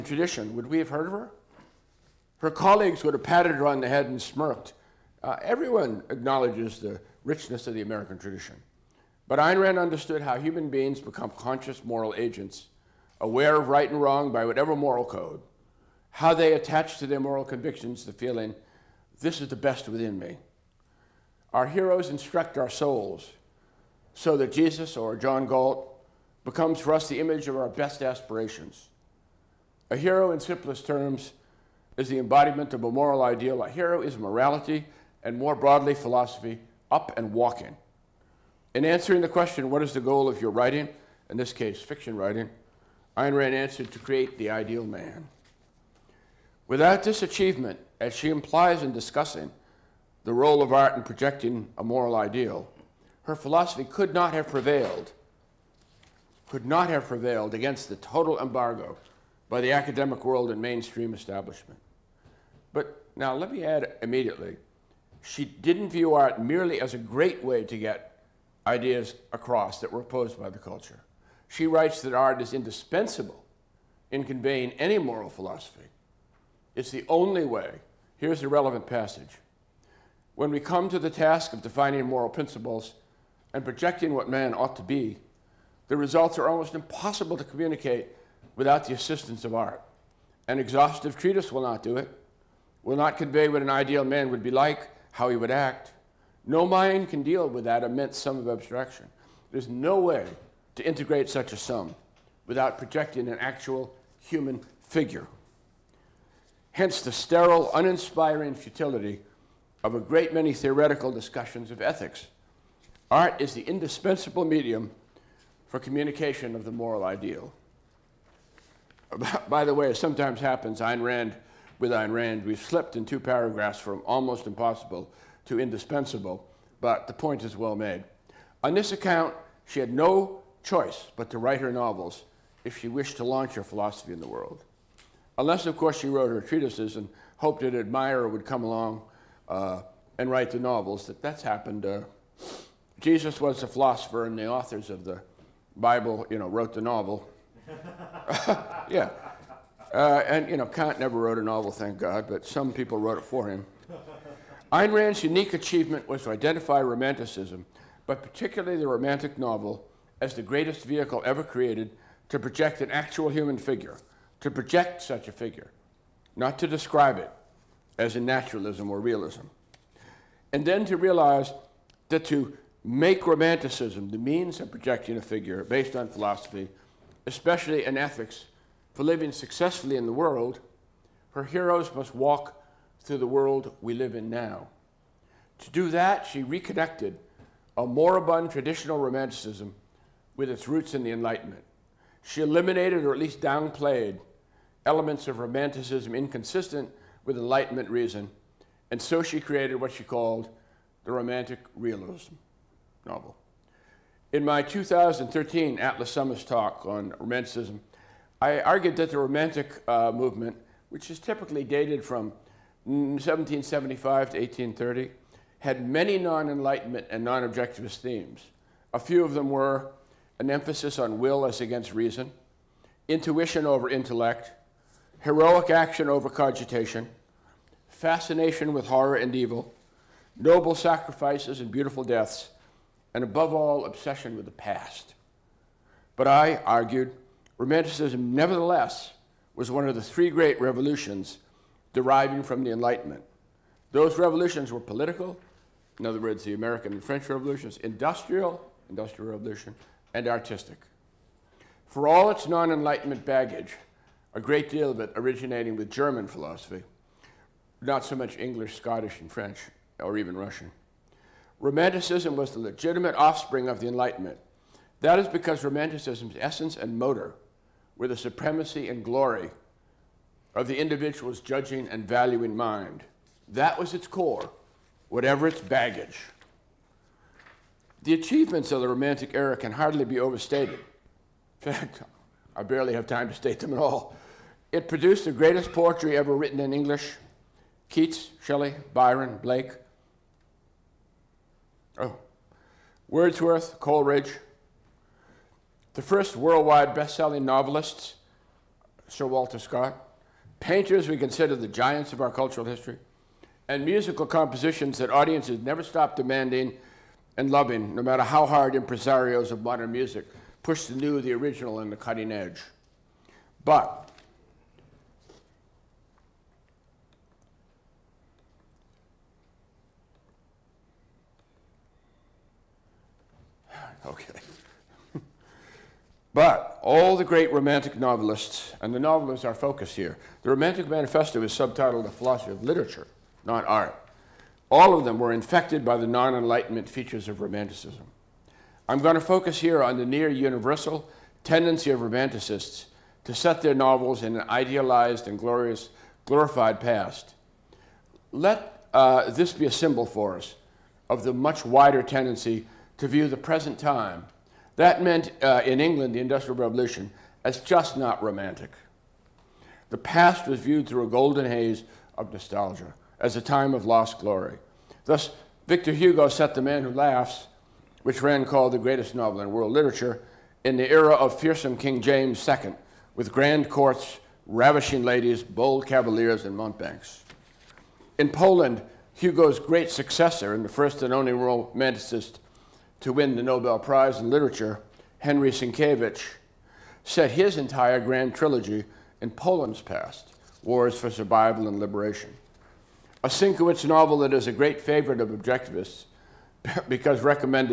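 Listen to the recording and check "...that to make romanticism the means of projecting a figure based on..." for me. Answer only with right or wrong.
right.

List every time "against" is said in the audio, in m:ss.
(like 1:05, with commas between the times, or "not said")
0:57, 3:41.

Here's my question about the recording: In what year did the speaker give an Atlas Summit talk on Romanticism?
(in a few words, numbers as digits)
2013.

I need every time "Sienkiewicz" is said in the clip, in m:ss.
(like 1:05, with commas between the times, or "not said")
6:25, 6:33.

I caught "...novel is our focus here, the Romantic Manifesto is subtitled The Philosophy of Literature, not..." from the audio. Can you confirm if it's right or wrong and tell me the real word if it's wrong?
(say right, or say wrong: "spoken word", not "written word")
right.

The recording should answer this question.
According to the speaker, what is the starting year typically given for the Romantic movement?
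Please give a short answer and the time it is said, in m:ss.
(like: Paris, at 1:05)
1775, at 3:32.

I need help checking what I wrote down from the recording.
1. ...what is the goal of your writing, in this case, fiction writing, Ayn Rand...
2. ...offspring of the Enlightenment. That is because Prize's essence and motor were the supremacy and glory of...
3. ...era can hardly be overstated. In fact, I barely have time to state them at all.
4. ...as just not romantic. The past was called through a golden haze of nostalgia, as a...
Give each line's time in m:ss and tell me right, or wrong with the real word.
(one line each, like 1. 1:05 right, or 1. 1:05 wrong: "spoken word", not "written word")
1. 0:39 right
2. 4:23 wrong: "Romanticism", not "Prize"
3. 4:39 right
4. 5:57 wrong: "viewed", not "called".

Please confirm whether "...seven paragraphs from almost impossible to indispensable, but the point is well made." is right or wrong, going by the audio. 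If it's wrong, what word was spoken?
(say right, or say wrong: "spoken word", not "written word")
wrong: "two", not "seven".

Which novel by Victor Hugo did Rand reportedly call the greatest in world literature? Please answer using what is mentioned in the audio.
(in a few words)
The Man Who Laughs.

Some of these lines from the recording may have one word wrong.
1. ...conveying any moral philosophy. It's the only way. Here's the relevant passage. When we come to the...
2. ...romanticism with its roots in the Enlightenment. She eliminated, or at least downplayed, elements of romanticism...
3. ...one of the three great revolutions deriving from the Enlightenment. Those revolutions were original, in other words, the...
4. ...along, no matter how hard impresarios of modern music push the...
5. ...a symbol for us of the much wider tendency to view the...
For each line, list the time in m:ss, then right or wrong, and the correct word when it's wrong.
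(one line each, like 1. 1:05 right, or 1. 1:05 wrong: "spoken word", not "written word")
1. 1:14 right
2. 3:08 right
3. 3:59 wrong: "political", not "original"
4. 5:07 wrong: "loving", not "along"
5. 5:49 right.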